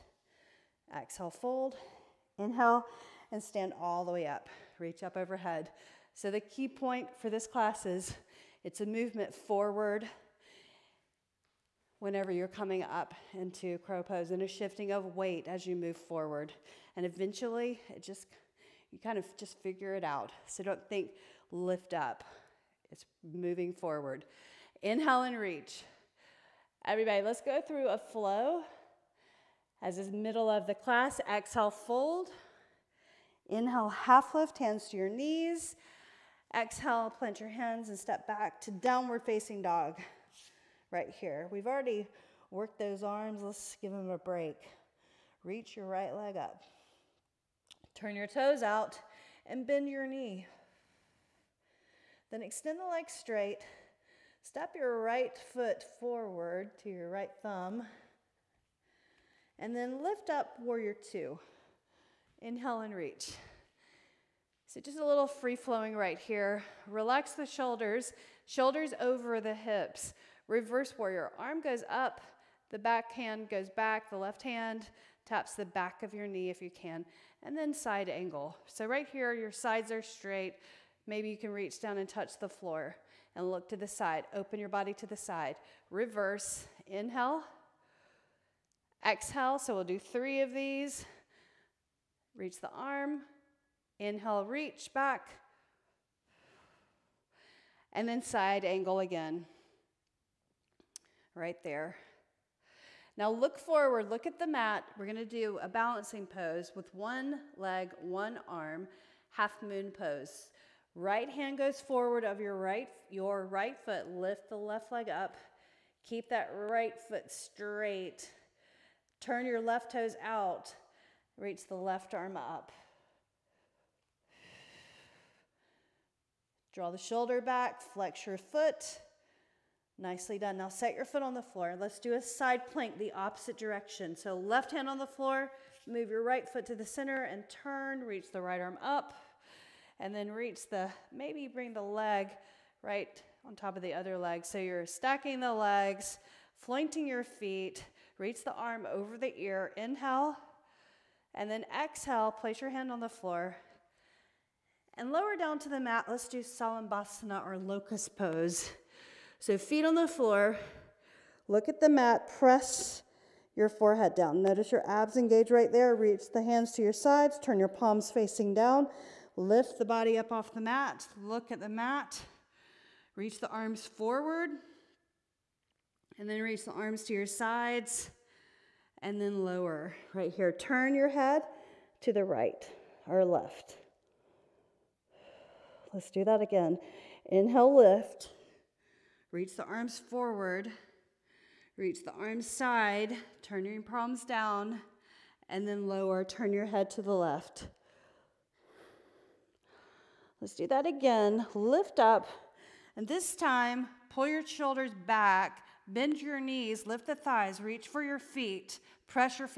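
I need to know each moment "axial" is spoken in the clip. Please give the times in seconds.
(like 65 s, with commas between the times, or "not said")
not said.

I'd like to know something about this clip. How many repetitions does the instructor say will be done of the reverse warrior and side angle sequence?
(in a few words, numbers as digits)
3.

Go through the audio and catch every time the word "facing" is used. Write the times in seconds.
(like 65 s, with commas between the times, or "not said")
39 s, 168 s.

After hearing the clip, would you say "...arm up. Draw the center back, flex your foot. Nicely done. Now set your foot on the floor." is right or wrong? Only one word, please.
wrong.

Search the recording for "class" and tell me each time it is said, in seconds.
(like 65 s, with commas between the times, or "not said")
7 s, 30 s.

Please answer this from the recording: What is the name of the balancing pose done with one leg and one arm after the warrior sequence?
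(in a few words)
Half moon pose.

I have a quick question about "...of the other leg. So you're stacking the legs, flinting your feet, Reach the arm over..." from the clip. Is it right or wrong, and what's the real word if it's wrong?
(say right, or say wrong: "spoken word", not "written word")
right.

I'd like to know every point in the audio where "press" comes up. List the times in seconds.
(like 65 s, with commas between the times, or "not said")
162 s, 209 s.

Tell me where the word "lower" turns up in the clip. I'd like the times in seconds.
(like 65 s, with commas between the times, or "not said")
155 s, 179 s, 195 s.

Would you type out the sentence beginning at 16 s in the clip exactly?
And eventually, it just you kind of just figure it out.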